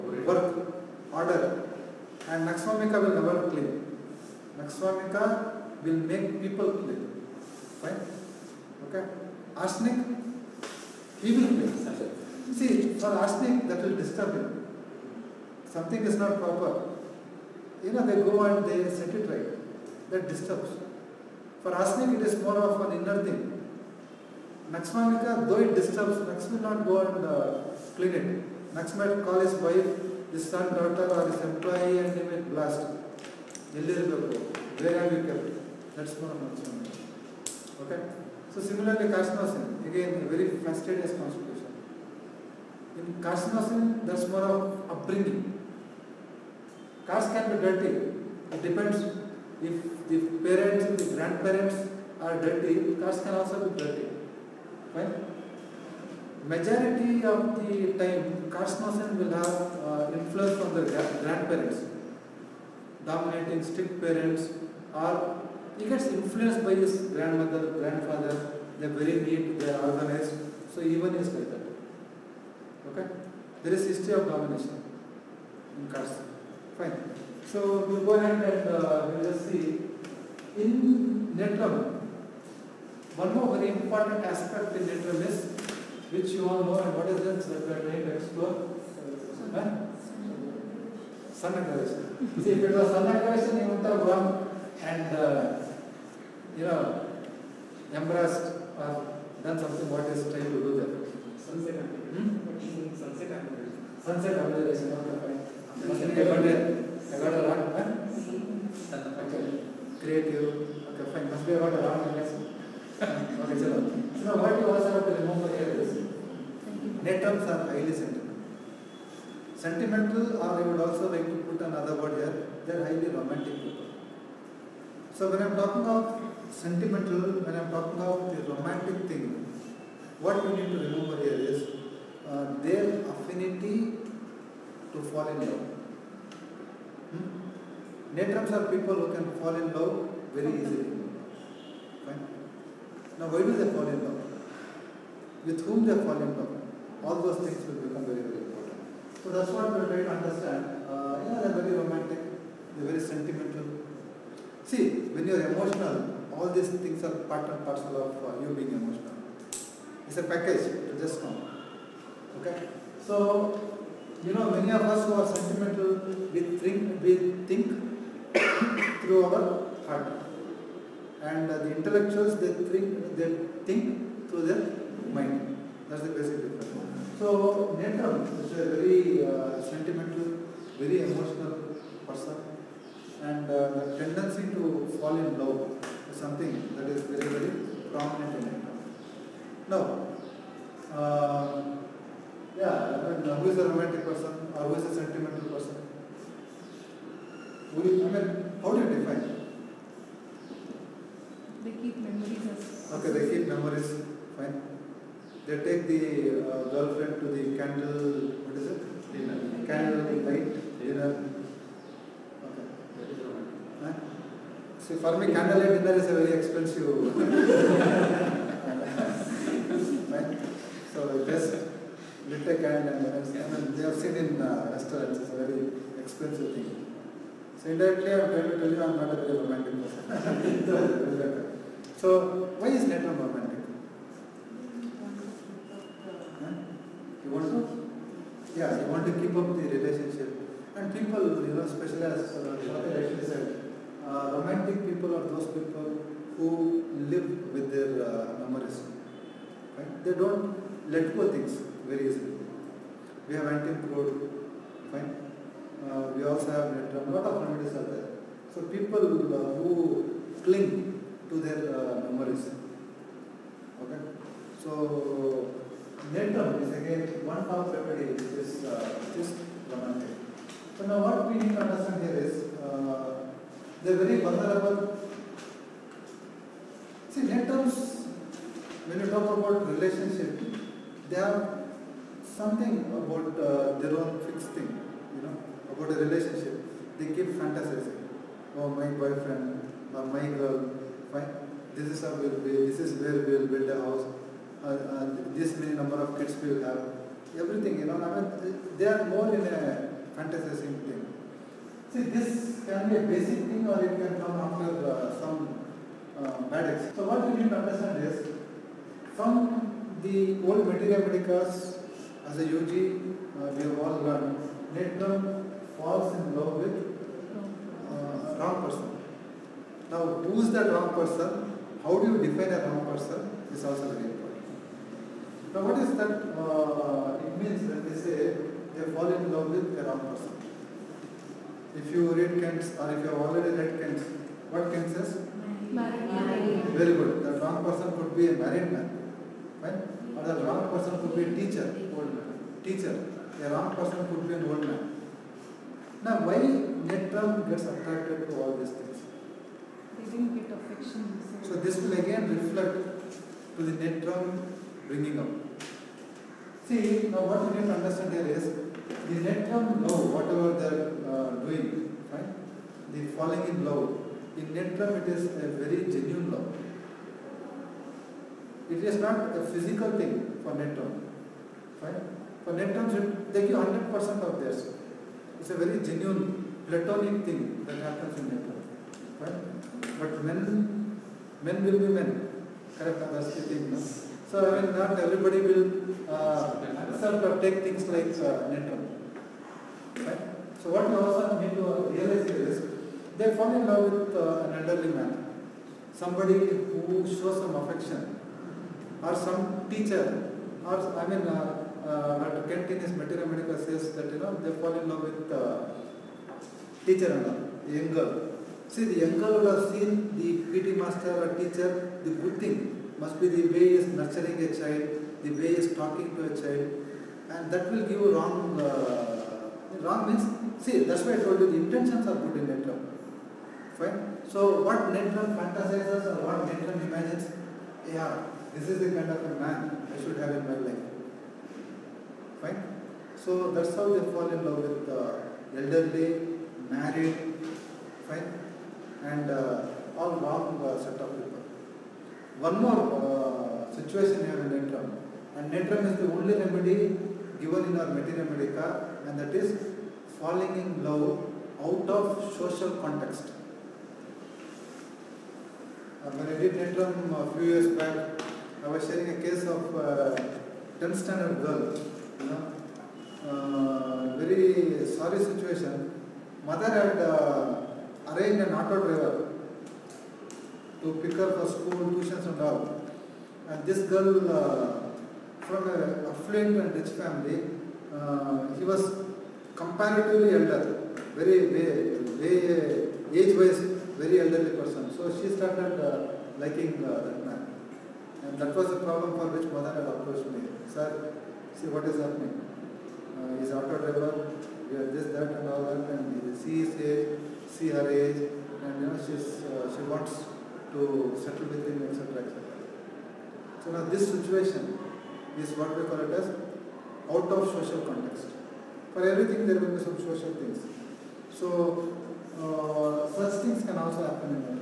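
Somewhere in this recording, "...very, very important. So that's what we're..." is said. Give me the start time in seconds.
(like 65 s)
148 s.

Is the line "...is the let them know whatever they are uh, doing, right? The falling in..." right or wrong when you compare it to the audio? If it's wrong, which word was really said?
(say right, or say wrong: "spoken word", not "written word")
right.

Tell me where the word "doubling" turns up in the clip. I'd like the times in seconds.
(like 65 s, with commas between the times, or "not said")
not said.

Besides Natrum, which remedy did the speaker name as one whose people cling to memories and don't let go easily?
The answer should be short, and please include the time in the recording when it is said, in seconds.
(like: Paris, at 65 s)
Antim crud, at 253 s.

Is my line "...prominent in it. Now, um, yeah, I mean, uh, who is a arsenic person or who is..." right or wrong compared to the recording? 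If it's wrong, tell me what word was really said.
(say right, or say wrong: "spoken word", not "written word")
wrong: "romantic", not "arsenic".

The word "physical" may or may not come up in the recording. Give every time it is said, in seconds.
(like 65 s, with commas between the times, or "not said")
369 s.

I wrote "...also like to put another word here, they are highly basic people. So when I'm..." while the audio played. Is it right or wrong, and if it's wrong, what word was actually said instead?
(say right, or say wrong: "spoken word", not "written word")
wrong: "romantic", not "basic".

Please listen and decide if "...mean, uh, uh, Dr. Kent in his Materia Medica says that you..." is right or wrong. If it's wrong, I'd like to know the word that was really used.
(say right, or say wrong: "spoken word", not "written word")
right.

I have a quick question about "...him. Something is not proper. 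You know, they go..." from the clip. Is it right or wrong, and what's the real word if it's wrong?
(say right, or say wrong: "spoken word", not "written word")
right.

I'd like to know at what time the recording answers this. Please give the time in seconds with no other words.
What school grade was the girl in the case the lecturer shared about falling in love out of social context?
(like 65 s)
460 s.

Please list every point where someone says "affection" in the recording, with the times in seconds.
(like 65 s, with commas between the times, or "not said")
350 s, 397 s.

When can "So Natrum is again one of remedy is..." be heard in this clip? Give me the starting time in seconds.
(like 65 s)
264 s.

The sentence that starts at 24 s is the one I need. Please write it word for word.
Naxmanica, though it disturbs, Nax will not go and uh, clean it.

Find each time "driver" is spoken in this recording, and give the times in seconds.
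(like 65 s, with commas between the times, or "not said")
468 s, 493 s.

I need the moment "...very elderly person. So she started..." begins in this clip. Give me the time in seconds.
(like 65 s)
484 s.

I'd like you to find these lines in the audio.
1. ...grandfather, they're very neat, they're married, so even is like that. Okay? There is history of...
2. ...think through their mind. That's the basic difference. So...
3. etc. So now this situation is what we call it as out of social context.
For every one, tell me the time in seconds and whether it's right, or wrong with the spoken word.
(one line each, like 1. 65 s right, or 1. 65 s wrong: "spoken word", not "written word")
1. 67 s wrong: "organized", not "married"
2. 173 s right
3. 502 s right.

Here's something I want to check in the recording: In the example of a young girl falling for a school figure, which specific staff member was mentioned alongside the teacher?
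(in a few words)
PT master.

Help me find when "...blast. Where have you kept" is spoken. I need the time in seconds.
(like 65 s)
32 s.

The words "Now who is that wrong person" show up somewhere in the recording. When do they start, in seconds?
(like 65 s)
319 s.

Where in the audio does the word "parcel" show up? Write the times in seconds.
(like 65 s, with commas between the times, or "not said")
157 s.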